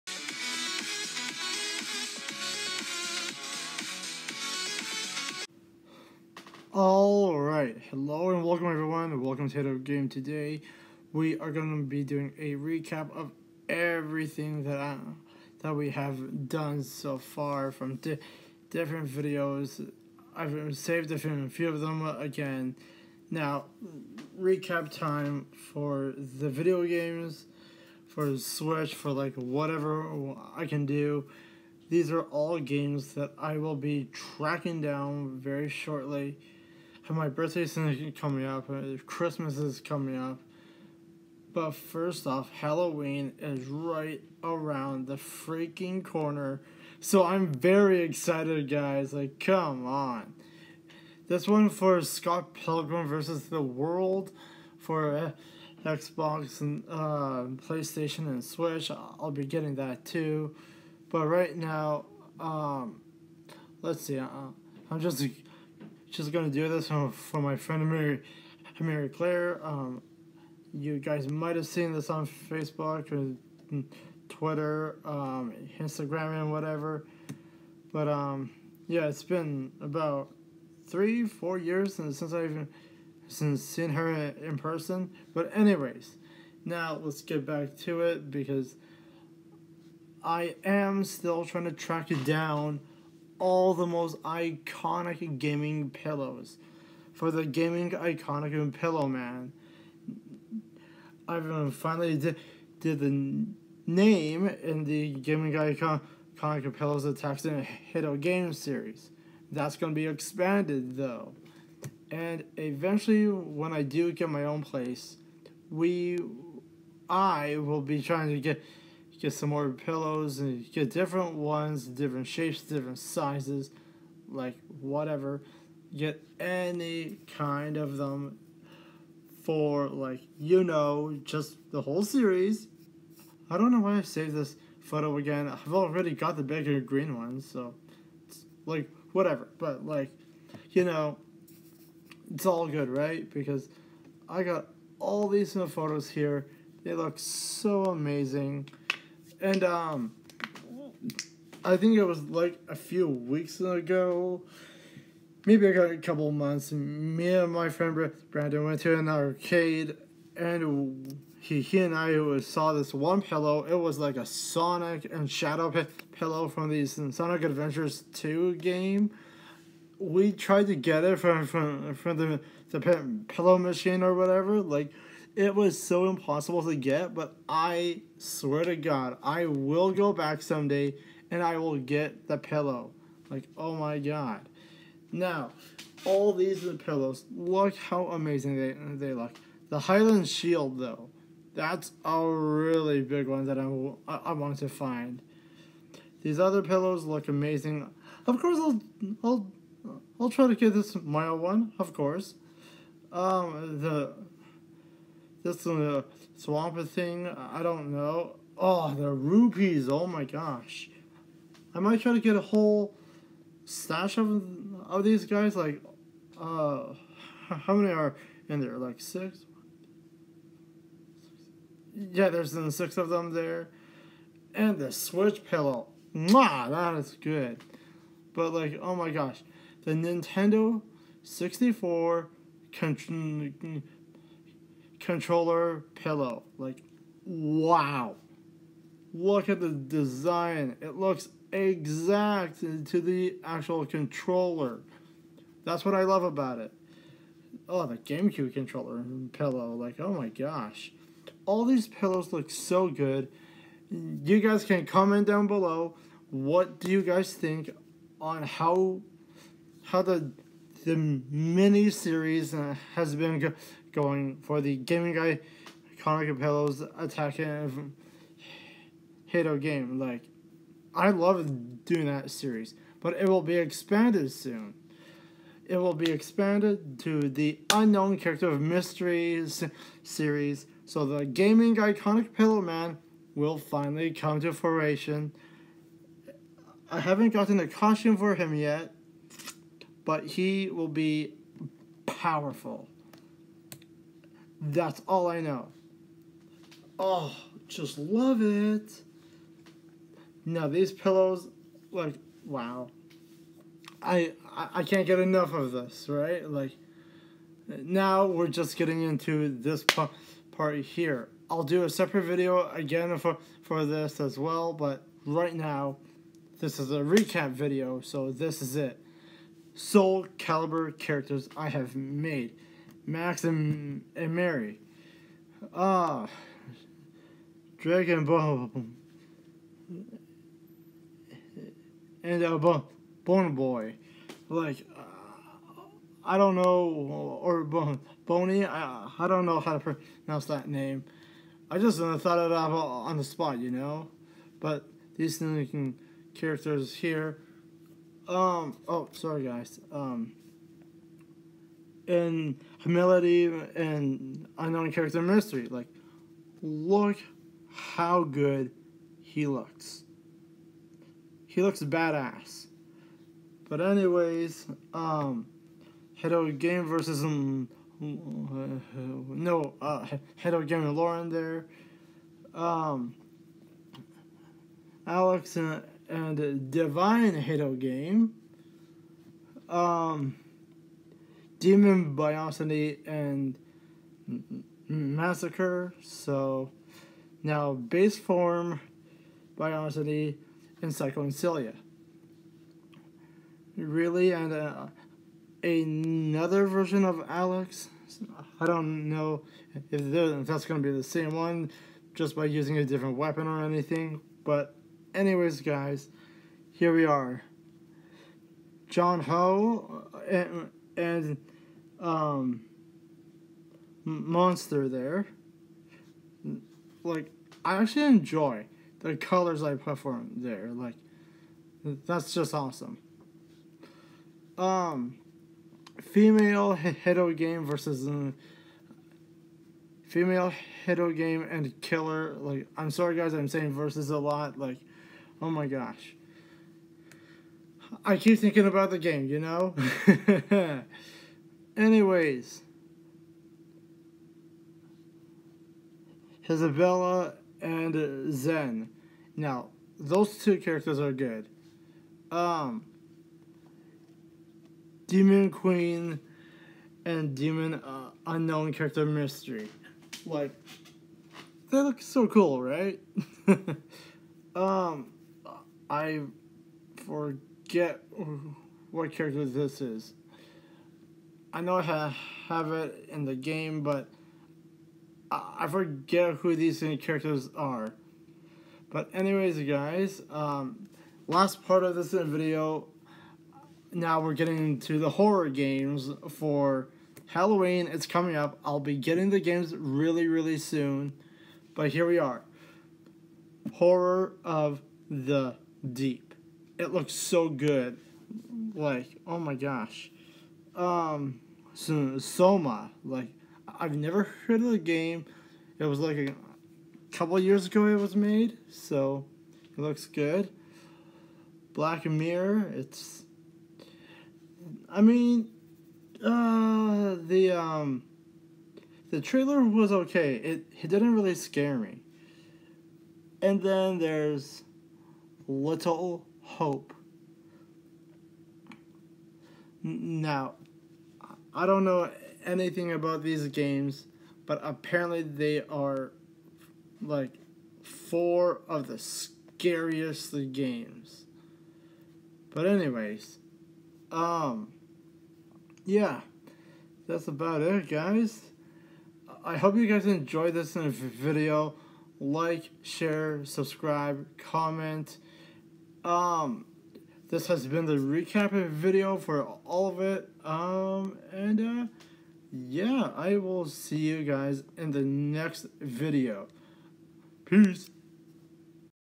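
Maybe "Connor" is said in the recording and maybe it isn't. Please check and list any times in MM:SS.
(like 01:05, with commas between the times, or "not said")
04:25.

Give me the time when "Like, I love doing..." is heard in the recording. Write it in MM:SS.
04:29.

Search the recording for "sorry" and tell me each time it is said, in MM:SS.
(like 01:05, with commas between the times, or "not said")
05:49, 07:12.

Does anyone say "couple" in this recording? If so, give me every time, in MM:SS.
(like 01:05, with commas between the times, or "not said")
02:35, 08:27.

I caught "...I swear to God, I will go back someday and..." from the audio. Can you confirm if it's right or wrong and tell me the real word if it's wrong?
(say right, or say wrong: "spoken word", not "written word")
right.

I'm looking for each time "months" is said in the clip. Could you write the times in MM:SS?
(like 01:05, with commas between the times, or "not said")
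02:36.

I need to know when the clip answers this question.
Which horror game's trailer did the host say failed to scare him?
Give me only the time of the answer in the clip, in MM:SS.
08:31.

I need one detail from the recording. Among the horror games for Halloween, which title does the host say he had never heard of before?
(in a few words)
Soma.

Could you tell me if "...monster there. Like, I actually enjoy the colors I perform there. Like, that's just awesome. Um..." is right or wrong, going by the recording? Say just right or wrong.
right.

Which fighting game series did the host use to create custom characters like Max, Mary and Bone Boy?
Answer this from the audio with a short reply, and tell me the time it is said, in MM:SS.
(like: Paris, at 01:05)
Soul Caliber, at 05:19.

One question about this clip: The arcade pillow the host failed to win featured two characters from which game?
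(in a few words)
Sonic Adventures Two.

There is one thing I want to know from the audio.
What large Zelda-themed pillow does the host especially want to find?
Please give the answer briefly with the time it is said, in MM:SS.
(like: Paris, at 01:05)
The Hylian Shield, at 03:09.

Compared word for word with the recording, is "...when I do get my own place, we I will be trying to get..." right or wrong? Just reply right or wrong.
right.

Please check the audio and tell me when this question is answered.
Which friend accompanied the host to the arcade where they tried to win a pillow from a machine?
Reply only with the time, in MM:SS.
02:38.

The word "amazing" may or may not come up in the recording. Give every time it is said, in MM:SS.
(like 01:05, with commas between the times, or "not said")
02:27, 03:08, 03:17.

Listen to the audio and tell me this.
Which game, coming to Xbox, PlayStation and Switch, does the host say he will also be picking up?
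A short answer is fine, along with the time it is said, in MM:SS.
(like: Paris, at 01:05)
Scott Pilgrim versus the World, at 00:52.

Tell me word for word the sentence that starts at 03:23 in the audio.
Um, the this a Swampert thing, I don't know.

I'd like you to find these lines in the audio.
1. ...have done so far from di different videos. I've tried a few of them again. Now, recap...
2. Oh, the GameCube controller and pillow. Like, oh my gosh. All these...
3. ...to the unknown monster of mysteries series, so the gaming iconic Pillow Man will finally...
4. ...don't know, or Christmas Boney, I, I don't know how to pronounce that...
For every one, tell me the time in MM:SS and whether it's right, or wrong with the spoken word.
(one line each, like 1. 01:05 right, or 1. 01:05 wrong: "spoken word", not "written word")
1. 00:15 wrong: "saved", not "tried"
2. 04:07 right
3. 04:37 wrong: "character", not "monster"
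4. 05:36 wrong: "Bone", not "Christmas".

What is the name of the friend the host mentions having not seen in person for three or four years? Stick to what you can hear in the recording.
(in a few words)
Mary Claire.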